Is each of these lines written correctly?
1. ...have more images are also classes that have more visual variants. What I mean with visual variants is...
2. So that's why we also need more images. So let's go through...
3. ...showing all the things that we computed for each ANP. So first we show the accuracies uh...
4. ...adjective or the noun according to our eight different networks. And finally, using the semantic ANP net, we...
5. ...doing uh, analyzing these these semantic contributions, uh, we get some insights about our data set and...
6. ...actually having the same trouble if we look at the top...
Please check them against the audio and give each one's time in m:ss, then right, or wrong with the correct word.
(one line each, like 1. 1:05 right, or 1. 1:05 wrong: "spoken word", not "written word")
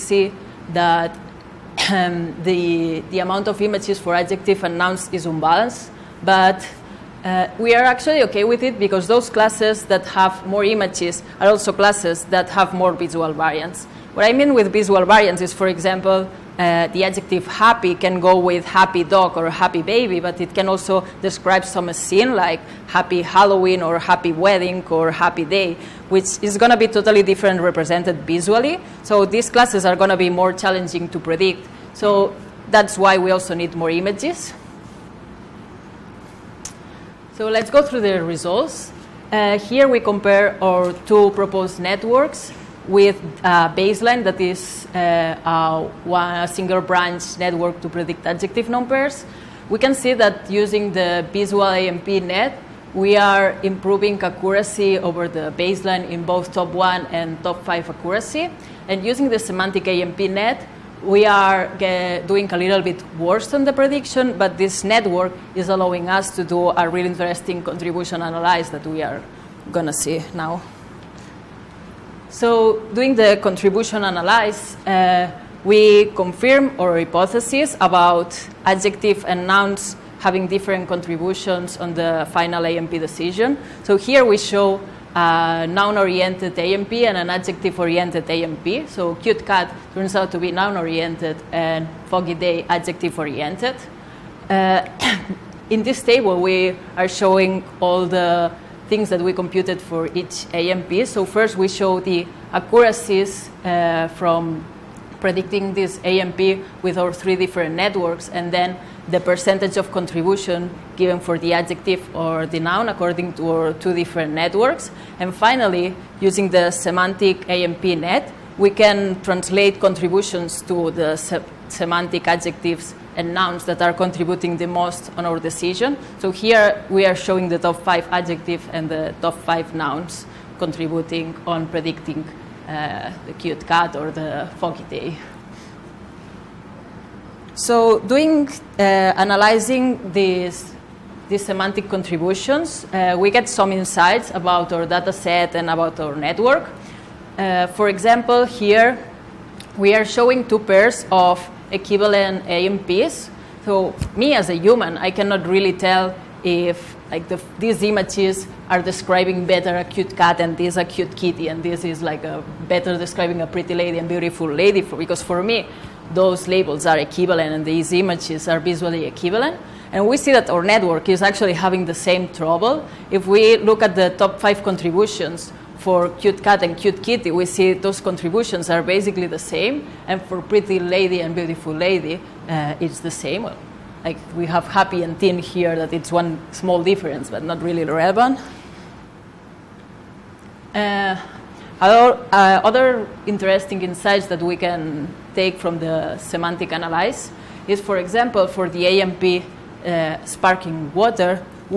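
1. 0:10 right
2. 0:31 right
3. 1:37 right
4. 1:51 wrong: "two", not "eight"
5. 2:17 right
6. 2:51 right.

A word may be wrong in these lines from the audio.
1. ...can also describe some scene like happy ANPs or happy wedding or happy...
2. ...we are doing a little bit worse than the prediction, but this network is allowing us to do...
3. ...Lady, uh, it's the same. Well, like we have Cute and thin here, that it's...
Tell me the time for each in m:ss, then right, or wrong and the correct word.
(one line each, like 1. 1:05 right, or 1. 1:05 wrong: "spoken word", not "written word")
1. 0:20 wrong: "Halloween", not "ANPs"
2. 1:01 right
3. 3:01 wrong: "Happy", not "Cute".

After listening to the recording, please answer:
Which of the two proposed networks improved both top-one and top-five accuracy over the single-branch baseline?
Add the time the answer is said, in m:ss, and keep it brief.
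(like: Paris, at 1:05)
Visual ANP net, at 0:51.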